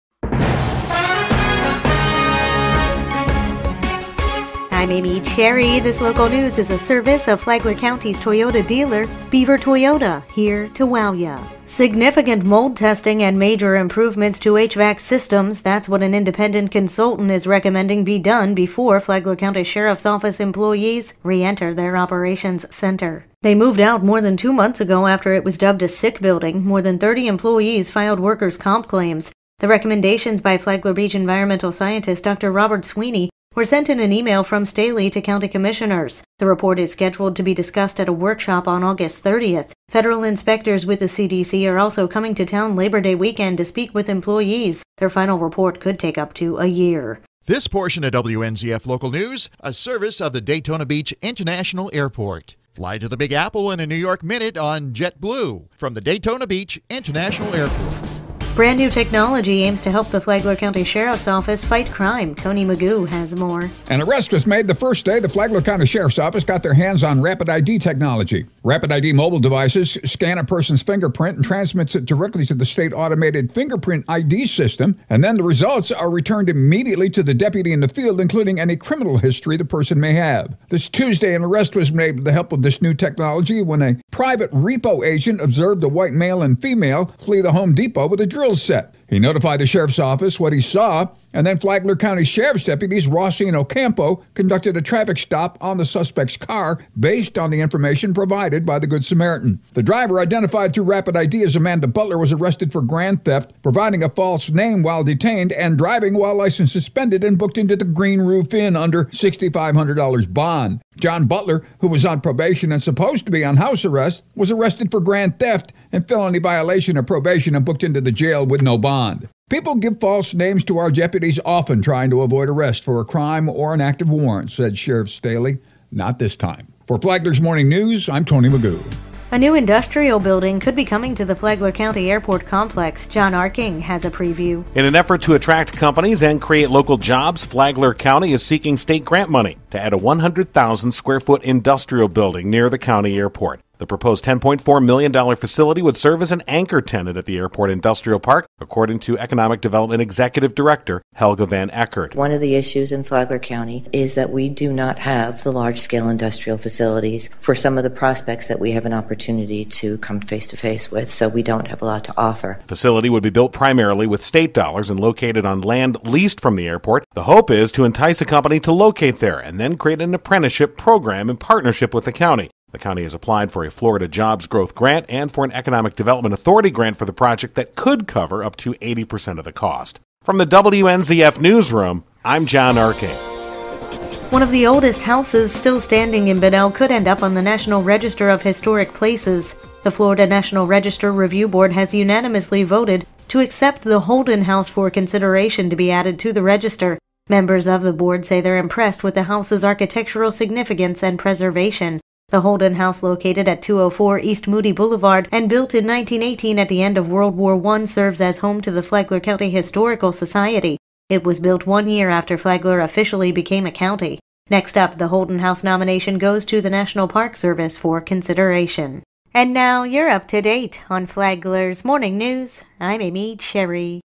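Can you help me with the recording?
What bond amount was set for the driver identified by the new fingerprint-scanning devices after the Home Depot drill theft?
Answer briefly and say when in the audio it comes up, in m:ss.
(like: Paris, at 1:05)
$6,500, at 1:49.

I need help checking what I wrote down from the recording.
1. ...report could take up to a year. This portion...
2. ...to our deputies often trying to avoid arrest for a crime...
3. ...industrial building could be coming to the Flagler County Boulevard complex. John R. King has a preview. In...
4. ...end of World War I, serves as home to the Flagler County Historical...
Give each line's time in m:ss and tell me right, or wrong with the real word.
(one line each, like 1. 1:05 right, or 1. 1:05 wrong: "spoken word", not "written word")
1. 0:45 right
2. 2:00 right
3. 2:09 wrong: "Airport", not "Boulevard"
4. 3:26 right.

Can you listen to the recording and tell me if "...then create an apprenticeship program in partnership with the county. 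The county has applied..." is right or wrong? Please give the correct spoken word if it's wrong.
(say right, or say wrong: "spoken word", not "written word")
right.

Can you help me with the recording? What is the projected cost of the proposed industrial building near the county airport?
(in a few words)
$10.4 million.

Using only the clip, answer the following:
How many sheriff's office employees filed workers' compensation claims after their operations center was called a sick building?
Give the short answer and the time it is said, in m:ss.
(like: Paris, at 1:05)
More than 30, at 0:26.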